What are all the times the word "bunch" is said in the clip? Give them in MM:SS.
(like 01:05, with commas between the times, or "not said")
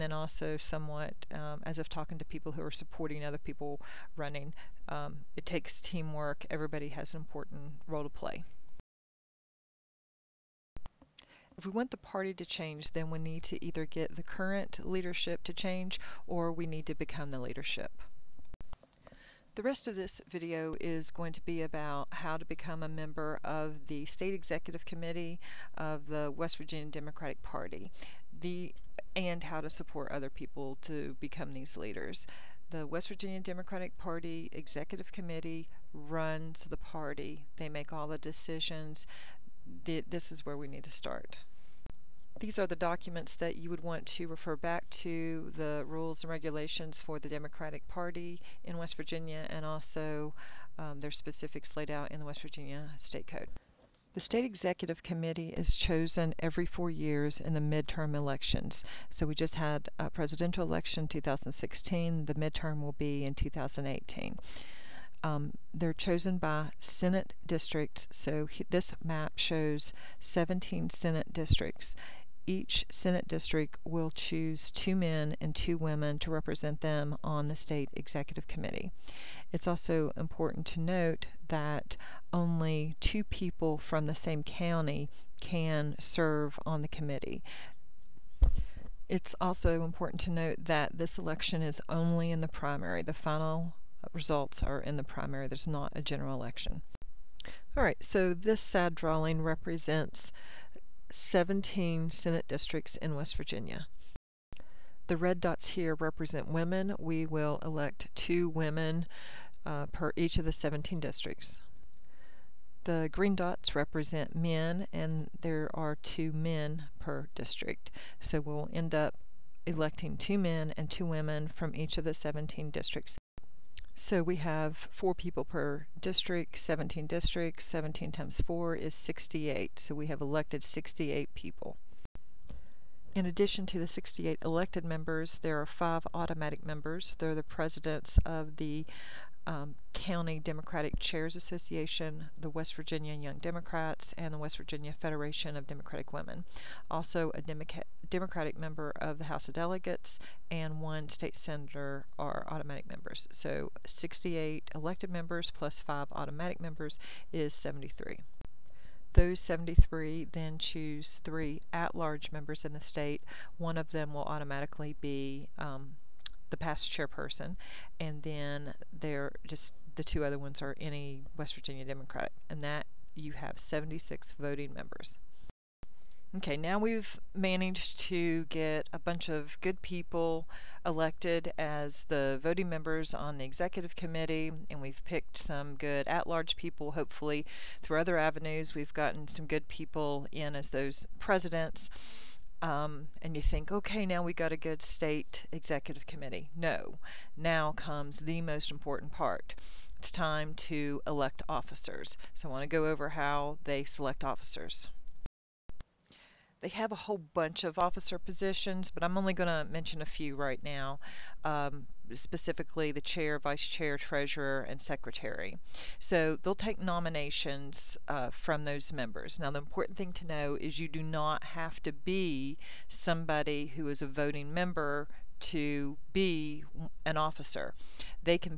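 02:58, 03:27.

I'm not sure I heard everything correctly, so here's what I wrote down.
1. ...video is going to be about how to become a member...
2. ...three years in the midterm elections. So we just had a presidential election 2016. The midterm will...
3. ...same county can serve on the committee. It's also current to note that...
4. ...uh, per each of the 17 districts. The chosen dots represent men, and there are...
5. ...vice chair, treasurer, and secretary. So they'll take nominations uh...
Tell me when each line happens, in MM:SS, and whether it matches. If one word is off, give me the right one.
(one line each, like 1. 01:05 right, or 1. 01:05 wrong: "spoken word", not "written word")
1. 00:20 right
2. 00:56 wrong: "four", not "three"
3. 01:24 wrong: "important", not "current"
4. 01:49 wrong: "green", not "chosen"
5. 03:33 right.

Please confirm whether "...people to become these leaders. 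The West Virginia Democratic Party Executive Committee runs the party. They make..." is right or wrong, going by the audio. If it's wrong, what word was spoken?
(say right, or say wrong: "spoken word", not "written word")
right.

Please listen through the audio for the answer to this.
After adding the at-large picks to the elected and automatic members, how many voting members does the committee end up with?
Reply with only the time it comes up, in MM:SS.
02:53.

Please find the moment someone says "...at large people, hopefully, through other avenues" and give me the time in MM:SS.
03:06.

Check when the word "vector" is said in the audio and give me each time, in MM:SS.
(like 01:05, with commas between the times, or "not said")
not said.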